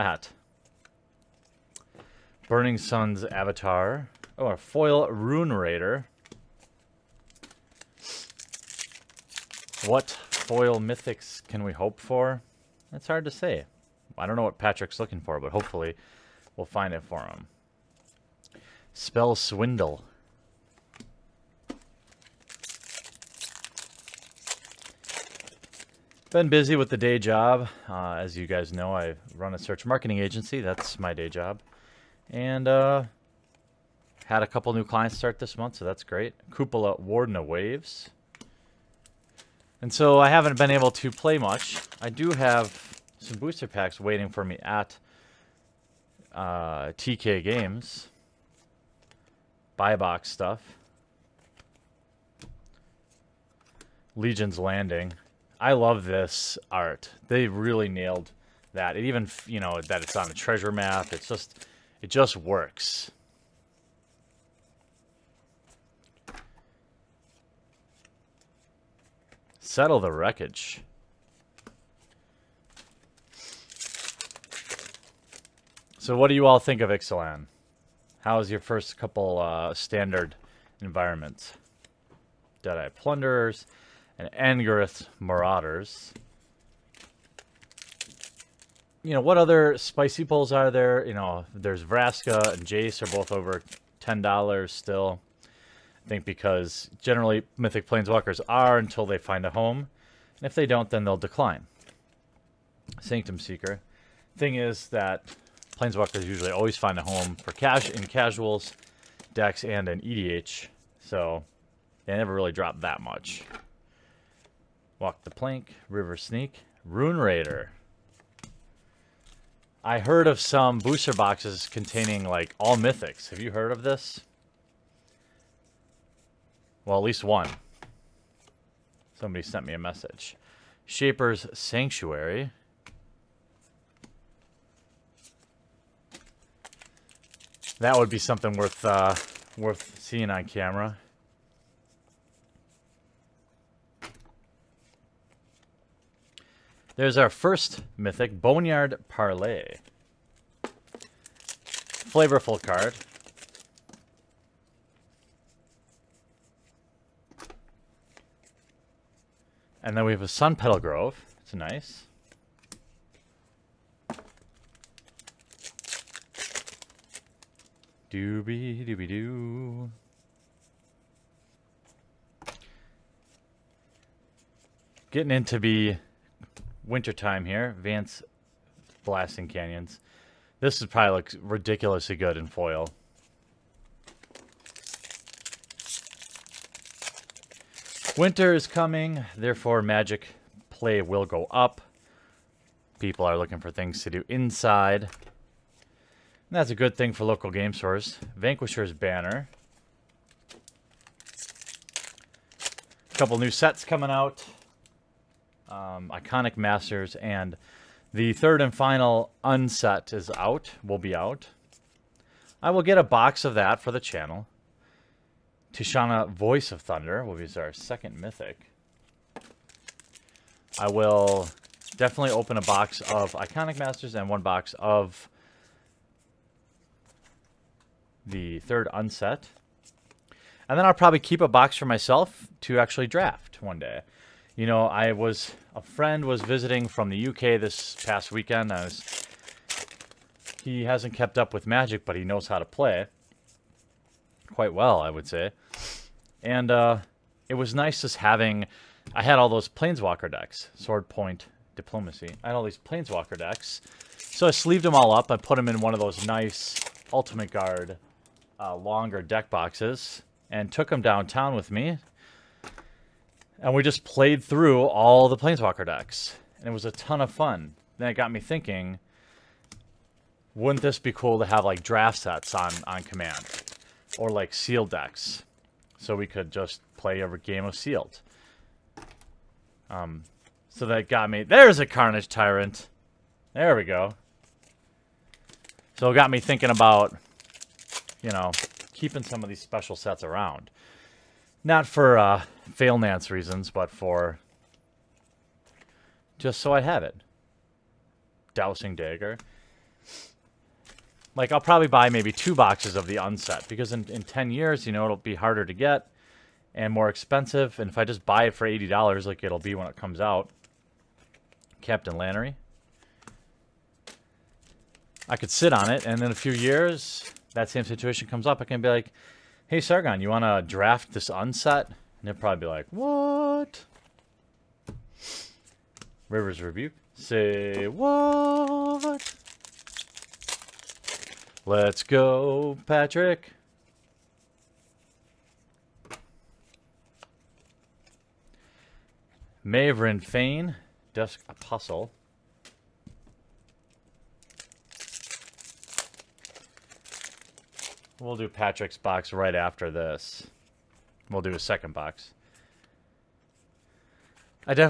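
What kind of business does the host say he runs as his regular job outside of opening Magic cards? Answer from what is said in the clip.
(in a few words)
Search marketing agency.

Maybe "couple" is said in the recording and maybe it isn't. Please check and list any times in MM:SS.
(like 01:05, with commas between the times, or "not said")
00:34, 01:18, 03:23.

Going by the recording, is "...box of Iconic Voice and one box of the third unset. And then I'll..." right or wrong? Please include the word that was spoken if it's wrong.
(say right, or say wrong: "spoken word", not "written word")
wrong: "Masters", not "Voice".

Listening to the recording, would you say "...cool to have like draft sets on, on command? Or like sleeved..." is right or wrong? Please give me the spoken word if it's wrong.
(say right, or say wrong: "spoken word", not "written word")
wrong: "sealed", not "sleeved".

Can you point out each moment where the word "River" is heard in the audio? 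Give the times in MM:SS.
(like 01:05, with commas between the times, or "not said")
01:55, 05:26.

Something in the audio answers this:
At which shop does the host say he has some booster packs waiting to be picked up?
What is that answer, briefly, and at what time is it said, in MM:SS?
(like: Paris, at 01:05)
TK Games, at 00:46.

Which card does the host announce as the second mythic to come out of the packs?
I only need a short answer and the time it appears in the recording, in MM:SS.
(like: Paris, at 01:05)
Tishana Voice of Thunder, at 03:35.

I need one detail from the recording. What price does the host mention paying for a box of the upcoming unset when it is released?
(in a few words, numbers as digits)
$80.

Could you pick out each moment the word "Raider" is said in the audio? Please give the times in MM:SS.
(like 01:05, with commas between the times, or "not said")
00:05, 01:57.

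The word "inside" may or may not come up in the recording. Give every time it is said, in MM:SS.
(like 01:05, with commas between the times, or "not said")
03:14.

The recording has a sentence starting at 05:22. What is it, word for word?
And they'll probably be like, what?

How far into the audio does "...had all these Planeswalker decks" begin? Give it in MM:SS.
04:12.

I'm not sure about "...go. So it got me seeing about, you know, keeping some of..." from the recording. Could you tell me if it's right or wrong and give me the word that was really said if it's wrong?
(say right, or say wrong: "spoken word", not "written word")
wrong: "thinking", not "seeing".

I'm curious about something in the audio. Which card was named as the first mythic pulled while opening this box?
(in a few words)
Boneyard Parley.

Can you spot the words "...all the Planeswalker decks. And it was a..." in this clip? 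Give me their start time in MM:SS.
04:24.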